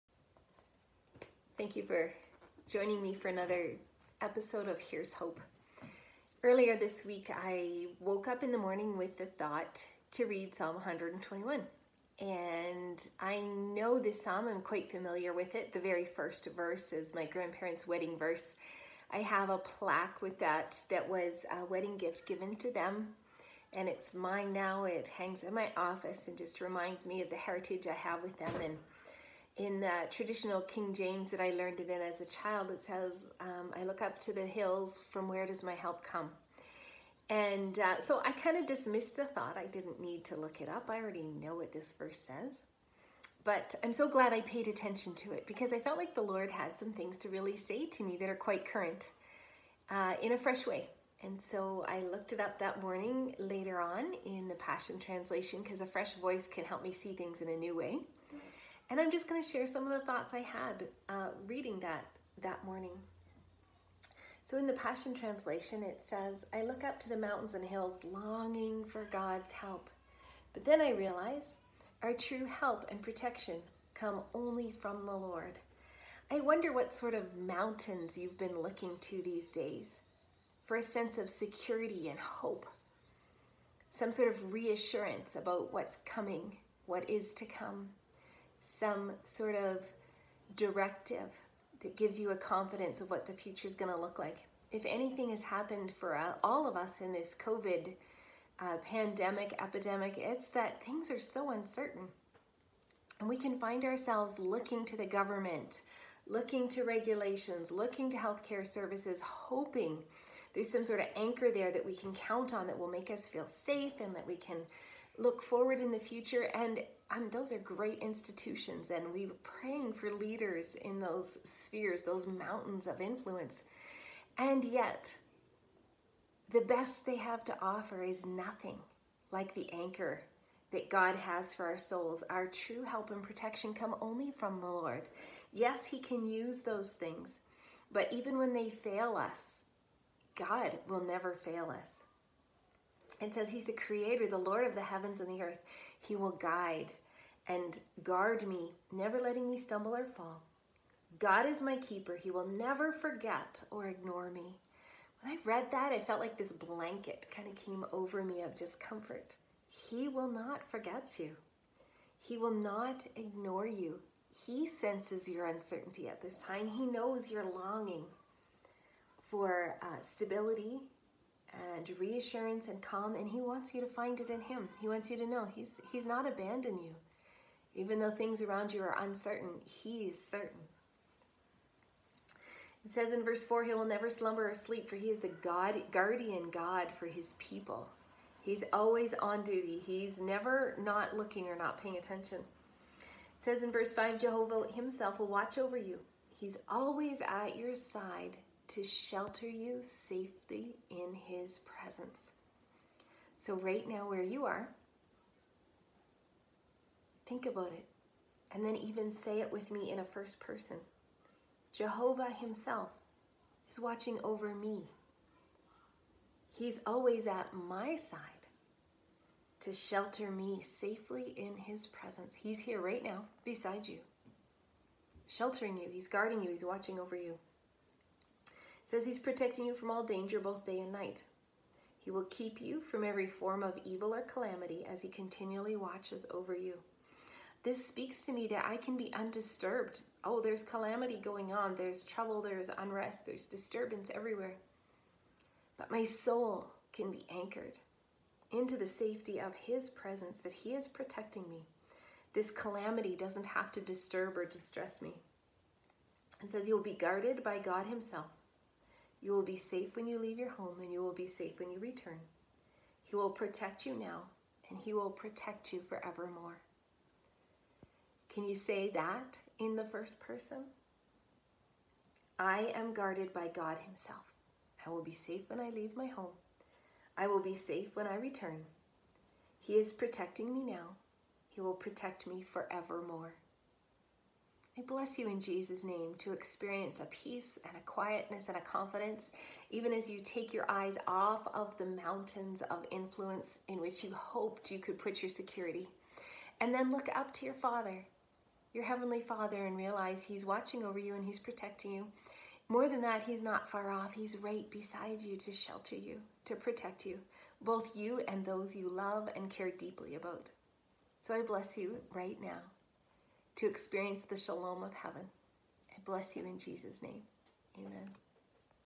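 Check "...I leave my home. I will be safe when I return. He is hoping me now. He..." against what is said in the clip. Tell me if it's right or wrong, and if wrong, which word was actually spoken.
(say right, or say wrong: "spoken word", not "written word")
wrong: "protecting", not "hoping".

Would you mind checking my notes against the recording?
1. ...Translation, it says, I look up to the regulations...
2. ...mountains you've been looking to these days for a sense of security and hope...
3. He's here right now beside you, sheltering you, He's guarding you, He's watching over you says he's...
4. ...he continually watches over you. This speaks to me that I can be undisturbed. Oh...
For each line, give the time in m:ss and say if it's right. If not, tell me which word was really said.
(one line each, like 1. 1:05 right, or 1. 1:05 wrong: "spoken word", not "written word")
1. 1:05 wrong: "mountains", not "regulations"
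2. 1:17 right
3. 3:42 right
4. 3:55 right.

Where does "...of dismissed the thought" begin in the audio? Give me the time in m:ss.
0:38.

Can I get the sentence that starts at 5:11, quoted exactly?
So I bless you right now to experience the shalom of heaven.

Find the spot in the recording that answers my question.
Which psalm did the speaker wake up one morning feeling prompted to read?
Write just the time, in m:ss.
0:10.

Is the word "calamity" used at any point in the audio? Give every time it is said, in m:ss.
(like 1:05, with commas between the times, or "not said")
3:54, 4:00, 4:12.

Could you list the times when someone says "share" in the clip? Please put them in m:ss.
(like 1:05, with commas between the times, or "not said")
0:59.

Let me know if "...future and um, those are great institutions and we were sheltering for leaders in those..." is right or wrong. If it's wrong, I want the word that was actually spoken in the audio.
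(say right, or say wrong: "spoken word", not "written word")
wrong: "praying", not "sheltering".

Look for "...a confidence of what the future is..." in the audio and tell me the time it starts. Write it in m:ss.
1:32.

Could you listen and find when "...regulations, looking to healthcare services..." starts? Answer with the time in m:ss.
1:46.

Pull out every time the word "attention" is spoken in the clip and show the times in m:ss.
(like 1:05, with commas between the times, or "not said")
0:44, 3:11.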